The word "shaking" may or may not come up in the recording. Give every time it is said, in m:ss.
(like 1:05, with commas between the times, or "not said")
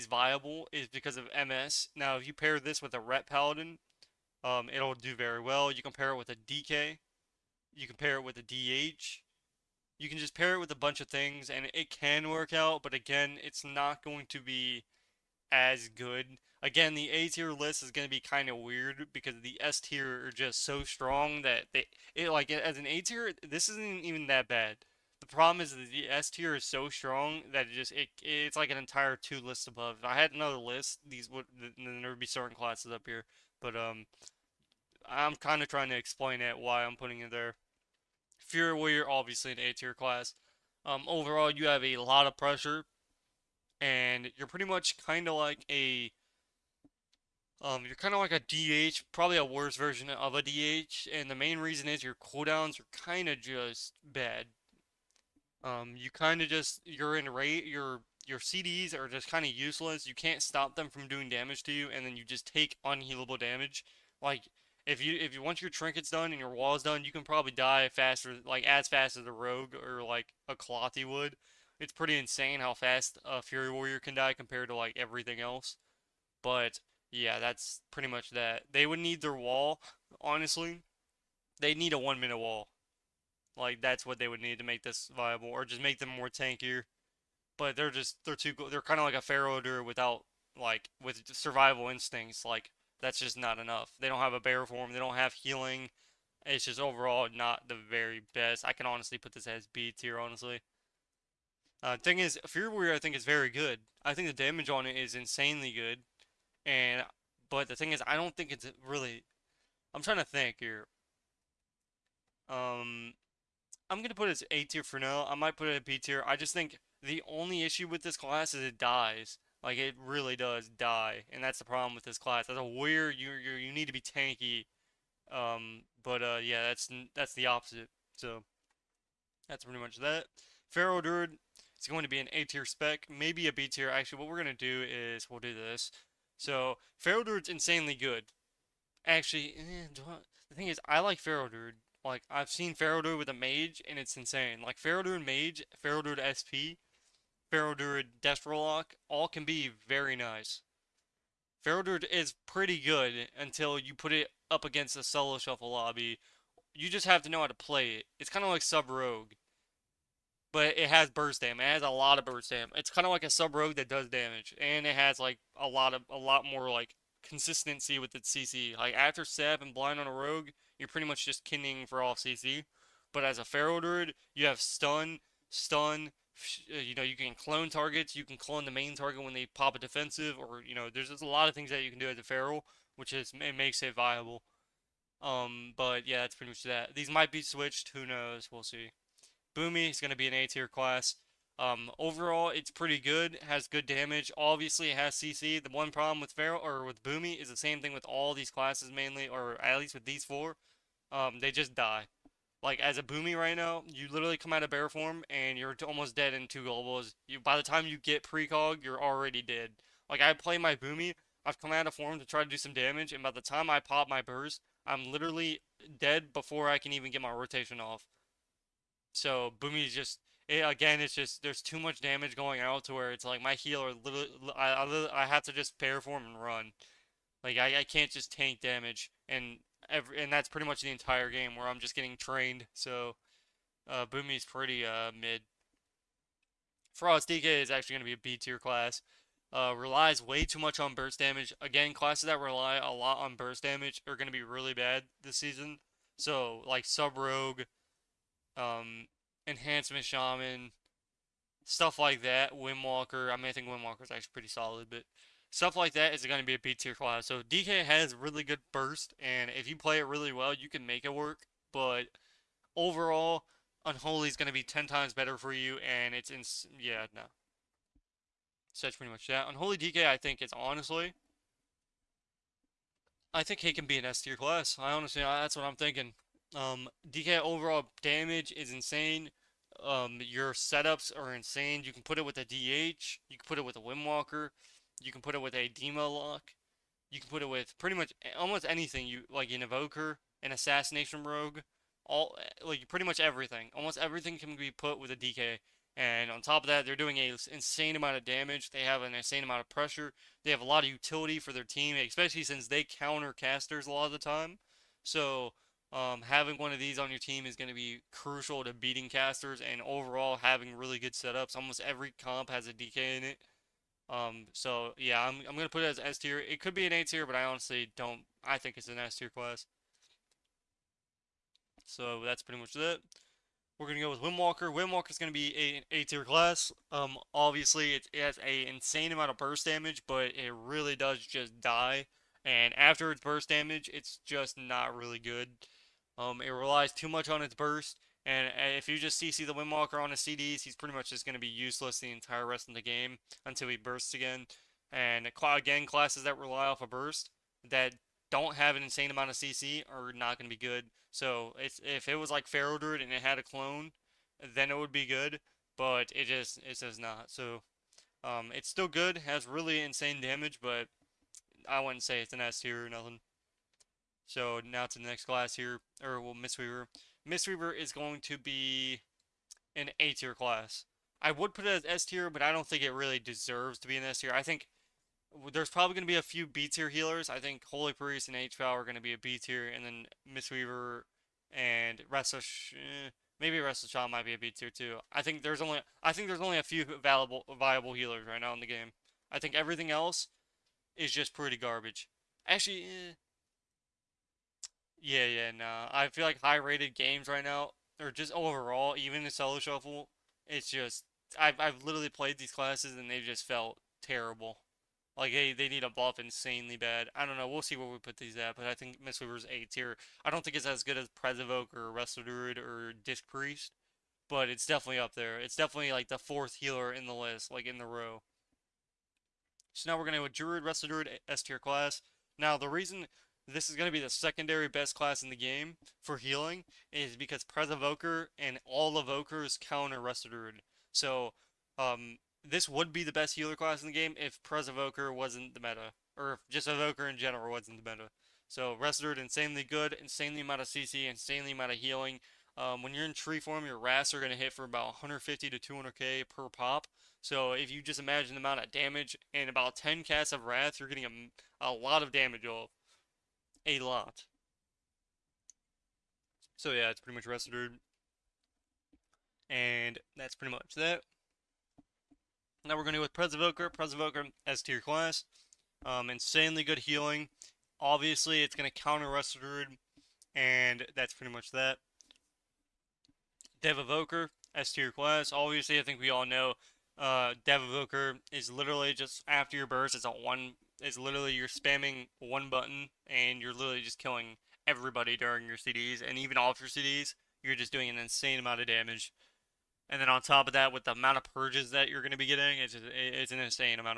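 not said.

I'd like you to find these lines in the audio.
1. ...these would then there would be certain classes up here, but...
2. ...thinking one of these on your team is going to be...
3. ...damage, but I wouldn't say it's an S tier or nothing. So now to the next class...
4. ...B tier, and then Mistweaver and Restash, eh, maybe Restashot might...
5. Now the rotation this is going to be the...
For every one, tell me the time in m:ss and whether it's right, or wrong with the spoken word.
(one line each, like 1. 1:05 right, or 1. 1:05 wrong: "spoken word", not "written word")
1. 0:31 right
2. 5:06 wrong: "having", not "thinking"
3. 6:00 right
4. 6:19 right
5. 7:02 wrong: "reason", not "rotation".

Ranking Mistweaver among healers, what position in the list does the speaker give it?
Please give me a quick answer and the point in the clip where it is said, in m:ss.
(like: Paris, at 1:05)
Fourth, at 6:56.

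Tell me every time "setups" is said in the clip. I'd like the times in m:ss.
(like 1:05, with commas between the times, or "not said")
4:40, 5:11.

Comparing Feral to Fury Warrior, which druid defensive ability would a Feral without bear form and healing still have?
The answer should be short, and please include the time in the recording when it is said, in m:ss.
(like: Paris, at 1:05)
Survival Instincts, at 1:31.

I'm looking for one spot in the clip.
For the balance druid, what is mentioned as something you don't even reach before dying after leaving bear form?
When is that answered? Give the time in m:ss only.
3:28.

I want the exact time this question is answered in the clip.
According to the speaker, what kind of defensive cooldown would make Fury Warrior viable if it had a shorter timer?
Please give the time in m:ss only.
1:21.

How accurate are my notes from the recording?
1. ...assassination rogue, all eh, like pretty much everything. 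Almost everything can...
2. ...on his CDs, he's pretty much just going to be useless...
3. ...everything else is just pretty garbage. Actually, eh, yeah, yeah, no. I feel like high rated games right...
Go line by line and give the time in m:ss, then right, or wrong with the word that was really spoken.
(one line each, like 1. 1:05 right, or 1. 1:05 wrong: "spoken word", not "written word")
1. 4:50 right
2. 5:40 right
3. 6:29 right.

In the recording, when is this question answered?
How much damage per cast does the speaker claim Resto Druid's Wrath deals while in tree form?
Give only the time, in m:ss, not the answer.
7:25.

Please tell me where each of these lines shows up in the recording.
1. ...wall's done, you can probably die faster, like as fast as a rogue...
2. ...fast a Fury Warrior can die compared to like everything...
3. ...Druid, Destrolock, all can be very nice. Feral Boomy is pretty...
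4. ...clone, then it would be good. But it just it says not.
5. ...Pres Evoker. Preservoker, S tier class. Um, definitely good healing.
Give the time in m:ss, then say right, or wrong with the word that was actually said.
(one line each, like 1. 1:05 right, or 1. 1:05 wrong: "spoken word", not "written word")
1. 1:06 right
2. 1:12 right
3. 2:27 wrong: "Druid", not "Boomy"
4. 5:53 right
5. 7:43 wrong: "insanely", not "definitely".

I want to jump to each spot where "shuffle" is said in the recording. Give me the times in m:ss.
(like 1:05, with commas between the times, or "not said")
2:35, 6:39.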